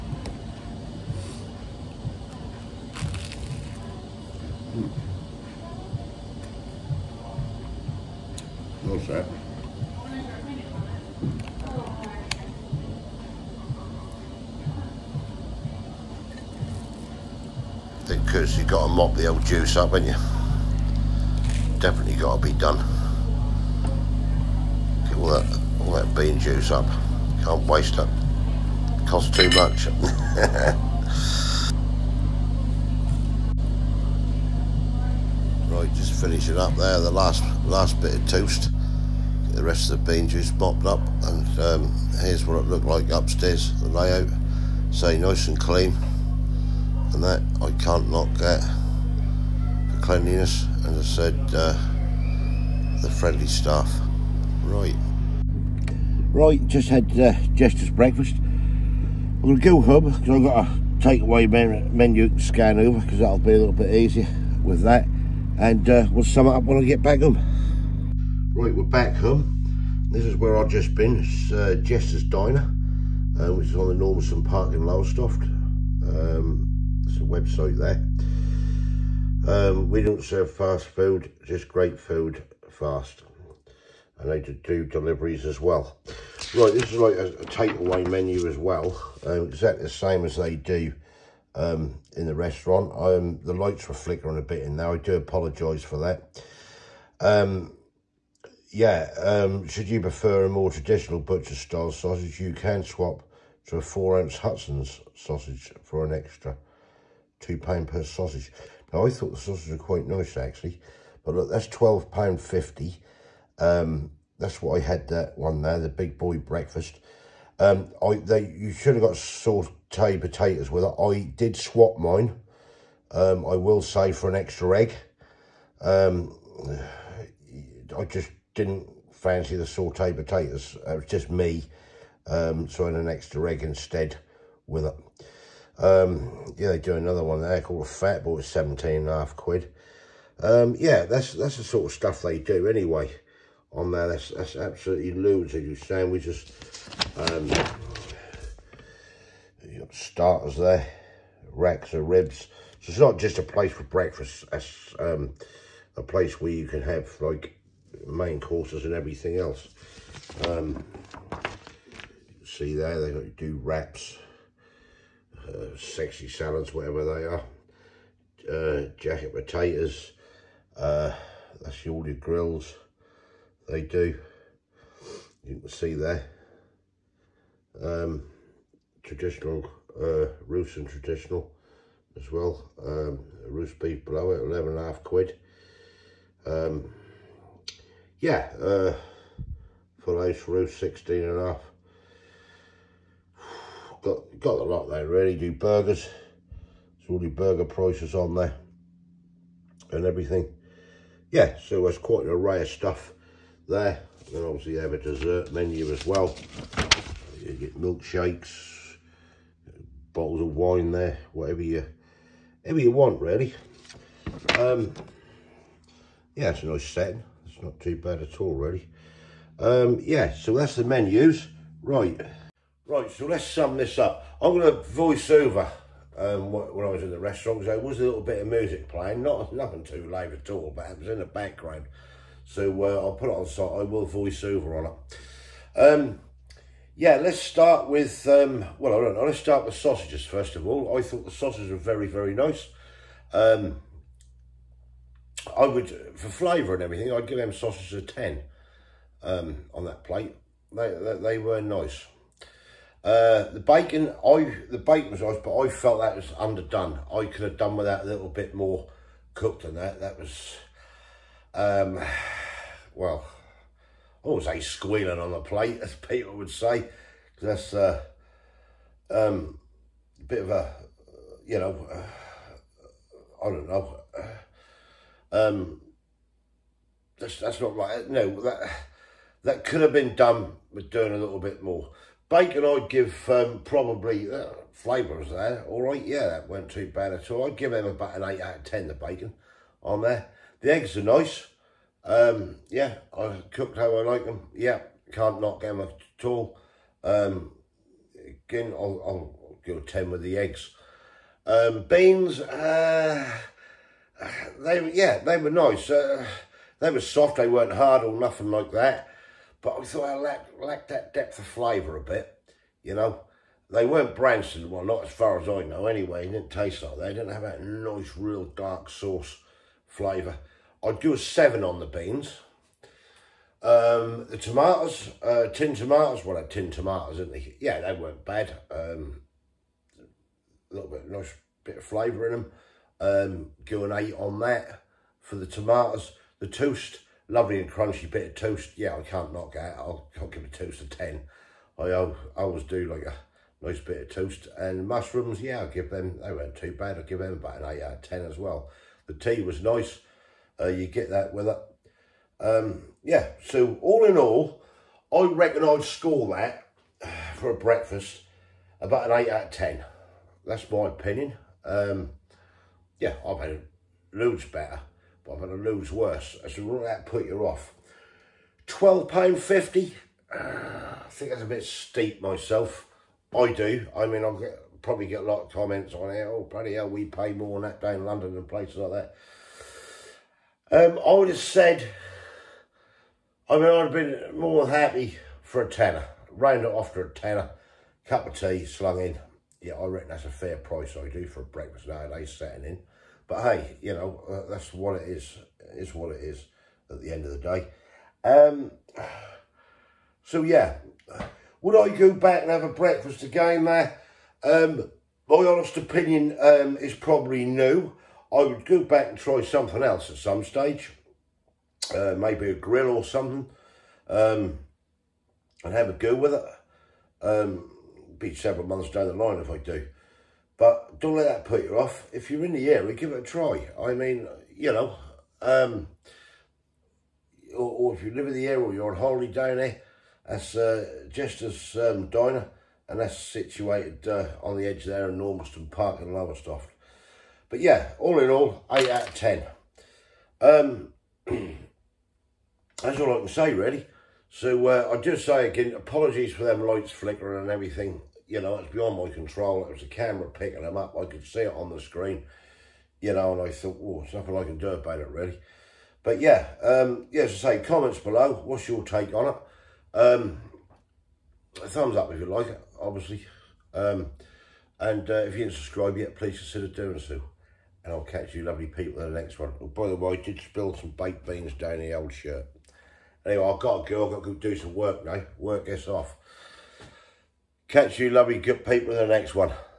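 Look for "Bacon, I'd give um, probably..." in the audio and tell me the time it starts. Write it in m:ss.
4:42.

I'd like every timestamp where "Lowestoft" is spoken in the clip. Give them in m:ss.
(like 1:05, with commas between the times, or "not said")
1:14, 7:16.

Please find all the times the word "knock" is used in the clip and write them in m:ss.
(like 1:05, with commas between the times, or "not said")
4:55, 5:39.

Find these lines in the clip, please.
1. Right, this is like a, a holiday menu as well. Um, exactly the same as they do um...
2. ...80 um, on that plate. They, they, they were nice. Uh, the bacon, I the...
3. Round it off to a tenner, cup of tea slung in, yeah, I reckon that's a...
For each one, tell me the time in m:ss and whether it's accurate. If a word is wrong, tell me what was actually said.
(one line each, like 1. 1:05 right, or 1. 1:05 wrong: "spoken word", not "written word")
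1. 1:26 wrong: "takeaway", not "holiday"
2. 4:08 wrong: "10", not "80"
3. 6:26 right.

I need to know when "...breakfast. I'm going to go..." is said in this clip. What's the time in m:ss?
0:57.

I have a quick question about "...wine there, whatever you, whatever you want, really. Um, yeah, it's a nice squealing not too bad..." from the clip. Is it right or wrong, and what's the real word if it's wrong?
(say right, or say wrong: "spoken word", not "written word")
wrong: "setting", not "squealing".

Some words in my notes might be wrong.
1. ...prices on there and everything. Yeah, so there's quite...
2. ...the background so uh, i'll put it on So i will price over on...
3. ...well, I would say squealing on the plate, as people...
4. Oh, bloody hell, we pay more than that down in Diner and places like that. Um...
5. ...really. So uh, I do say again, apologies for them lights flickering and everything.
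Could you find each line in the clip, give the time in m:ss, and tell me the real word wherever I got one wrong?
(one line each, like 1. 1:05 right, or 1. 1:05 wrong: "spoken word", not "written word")
1. 3:17 right
2. 3:51 wrong: "voice", not "price"
3. 4:22 right
4. 6:16 wrong: "London", not "Diner"
5. 7:23 right.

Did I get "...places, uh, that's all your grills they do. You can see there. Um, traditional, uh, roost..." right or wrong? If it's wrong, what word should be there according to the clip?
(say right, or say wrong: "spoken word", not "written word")
wrong: "potatoes", not "places".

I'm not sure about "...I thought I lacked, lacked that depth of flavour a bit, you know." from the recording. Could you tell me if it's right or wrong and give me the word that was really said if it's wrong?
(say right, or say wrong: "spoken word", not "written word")
right.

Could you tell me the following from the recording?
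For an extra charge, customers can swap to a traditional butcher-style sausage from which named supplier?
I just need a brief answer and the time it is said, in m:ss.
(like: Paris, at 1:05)
Hudson's, at 1:44.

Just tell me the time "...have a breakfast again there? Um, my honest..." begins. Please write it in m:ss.
6:42.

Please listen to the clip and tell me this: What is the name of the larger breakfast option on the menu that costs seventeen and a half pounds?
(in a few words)
Fat boy.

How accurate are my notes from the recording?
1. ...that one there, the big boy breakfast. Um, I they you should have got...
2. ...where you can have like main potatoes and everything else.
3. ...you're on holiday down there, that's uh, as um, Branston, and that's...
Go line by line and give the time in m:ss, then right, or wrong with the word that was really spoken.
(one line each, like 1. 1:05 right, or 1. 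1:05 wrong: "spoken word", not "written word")
1. 1:55 right
2. 2:36 wrong: "courses", not "potatoes"
3. 7:08 wrong: "Diner", not "Branston".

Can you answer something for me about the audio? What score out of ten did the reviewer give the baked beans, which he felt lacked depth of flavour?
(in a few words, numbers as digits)
7.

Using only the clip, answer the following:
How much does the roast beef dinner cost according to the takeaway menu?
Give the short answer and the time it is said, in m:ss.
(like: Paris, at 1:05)
£11.50, at 3:04.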